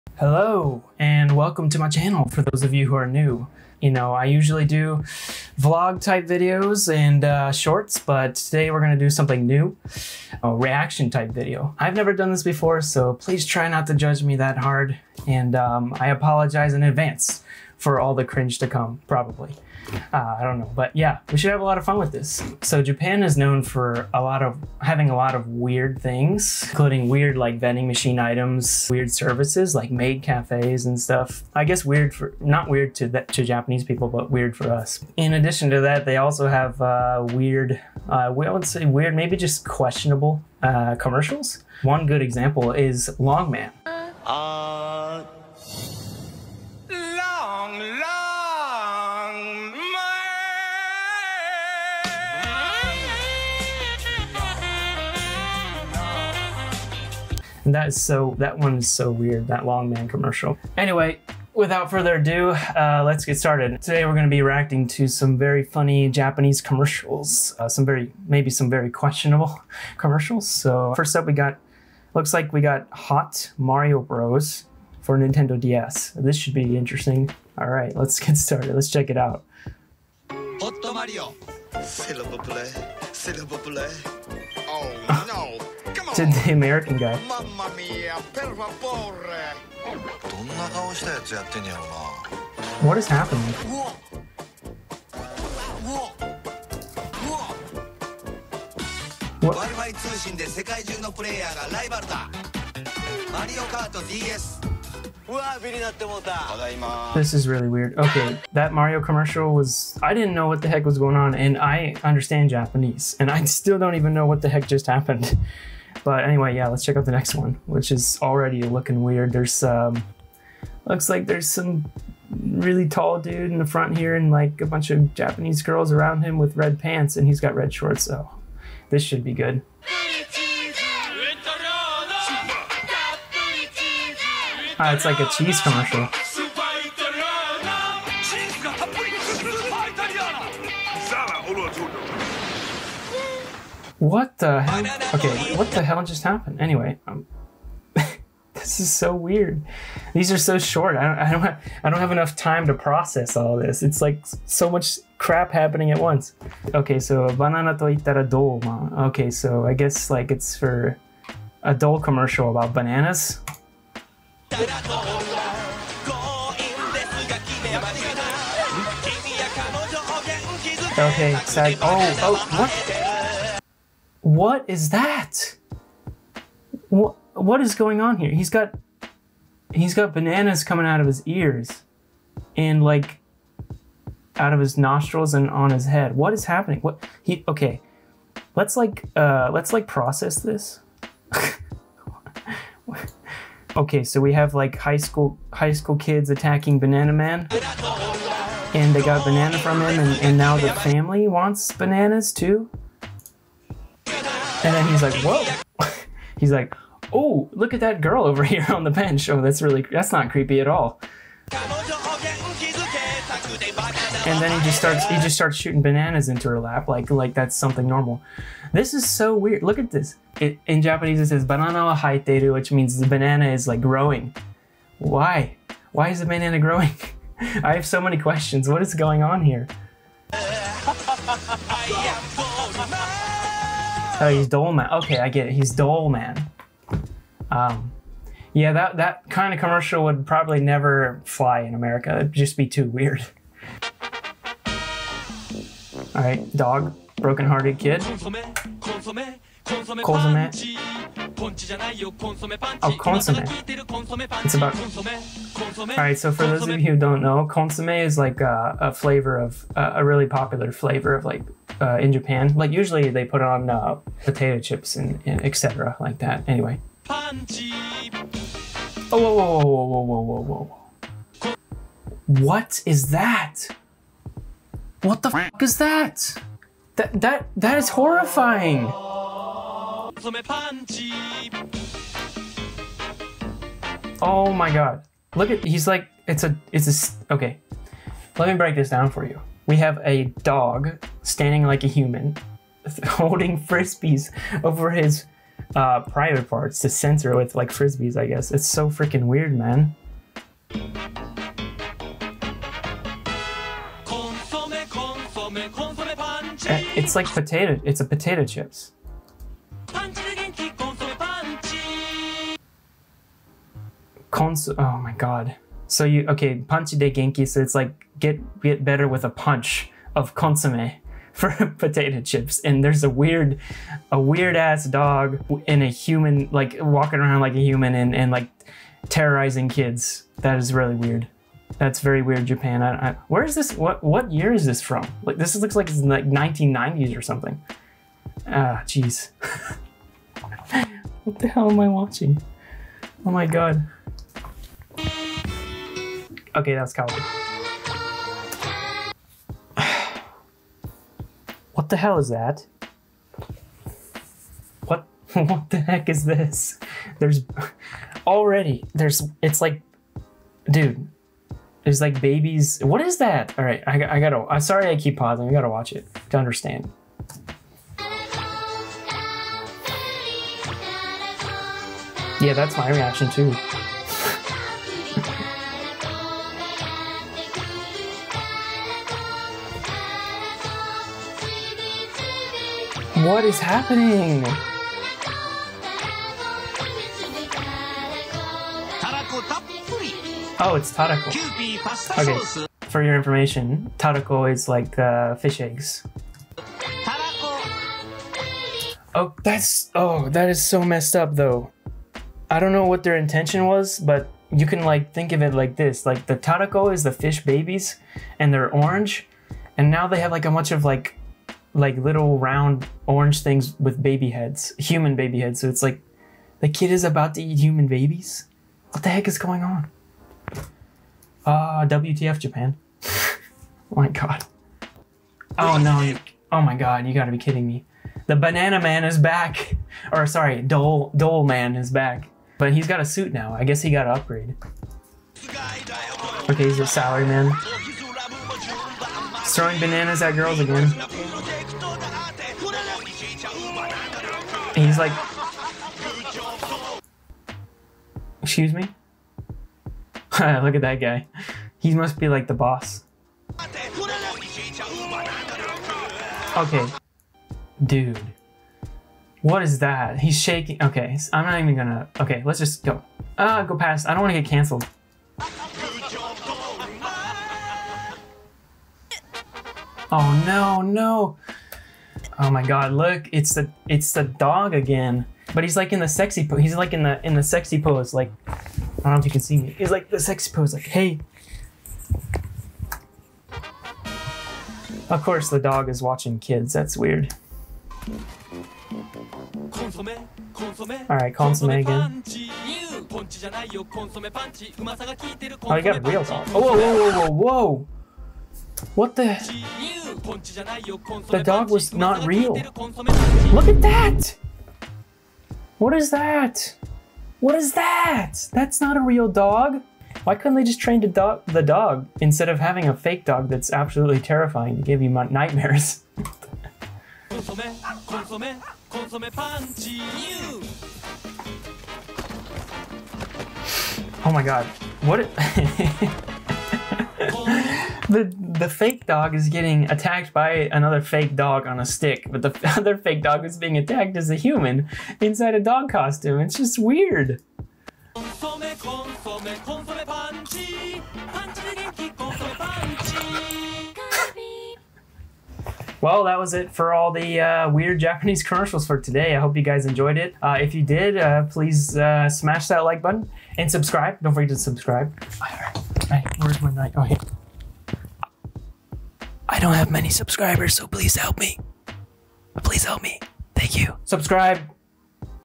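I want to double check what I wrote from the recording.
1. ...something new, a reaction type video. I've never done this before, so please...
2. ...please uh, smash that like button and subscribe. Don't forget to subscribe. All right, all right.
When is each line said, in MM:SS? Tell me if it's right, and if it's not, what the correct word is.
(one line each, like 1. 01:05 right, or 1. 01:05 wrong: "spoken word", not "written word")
1. 00:09 right
2. 09:11 right.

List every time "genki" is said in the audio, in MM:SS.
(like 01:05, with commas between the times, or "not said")
05:17.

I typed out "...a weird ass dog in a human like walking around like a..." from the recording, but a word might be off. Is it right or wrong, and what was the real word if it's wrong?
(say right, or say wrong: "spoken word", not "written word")
right.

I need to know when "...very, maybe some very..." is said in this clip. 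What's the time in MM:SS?
01:07.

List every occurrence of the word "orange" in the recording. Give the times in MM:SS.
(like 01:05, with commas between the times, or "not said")
06:48, 06:53.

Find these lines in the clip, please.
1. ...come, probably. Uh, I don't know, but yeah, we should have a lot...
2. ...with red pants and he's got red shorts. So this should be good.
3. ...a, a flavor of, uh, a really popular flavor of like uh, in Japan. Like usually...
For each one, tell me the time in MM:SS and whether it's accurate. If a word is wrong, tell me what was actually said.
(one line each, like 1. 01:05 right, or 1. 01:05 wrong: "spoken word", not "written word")
1. 00:18 right
2. 02:06 right
3. 04:18 right.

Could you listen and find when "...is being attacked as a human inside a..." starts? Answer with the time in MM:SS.
08:53.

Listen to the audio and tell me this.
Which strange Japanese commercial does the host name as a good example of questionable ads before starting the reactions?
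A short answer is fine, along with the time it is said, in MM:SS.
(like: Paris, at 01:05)
Longman, at 00:43.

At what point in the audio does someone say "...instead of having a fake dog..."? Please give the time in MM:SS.
08:32.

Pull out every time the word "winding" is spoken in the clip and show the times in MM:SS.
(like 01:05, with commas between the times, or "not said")
not said.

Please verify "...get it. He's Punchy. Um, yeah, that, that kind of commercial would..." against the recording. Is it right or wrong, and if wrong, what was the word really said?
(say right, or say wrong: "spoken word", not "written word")
wrong: "Doleman", not "Punchy".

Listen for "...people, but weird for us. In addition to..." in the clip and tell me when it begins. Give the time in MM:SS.
00:33.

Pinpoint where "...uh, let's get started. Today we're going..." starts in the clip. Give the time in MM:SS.
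01:02.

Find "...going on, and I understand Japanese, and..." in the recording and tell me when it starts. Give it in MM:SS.
01:50.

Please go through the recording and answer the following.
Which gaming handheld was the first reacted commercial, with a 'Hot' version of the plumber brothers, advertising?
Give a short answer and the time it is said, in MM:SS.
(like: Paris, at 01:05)
Nintendo DS, at 01:15.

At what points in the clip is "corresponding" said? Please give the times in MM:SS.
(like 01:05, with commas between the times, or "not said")
not said.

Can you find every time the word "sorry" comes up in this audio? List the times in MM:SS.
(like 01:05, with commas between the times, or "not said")
06:04, 07:10.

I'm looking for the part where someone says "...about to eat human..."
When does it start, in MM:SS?
06:57.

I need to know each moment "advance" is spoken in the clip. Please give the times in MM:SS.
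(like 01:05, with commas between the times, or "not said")
00:16.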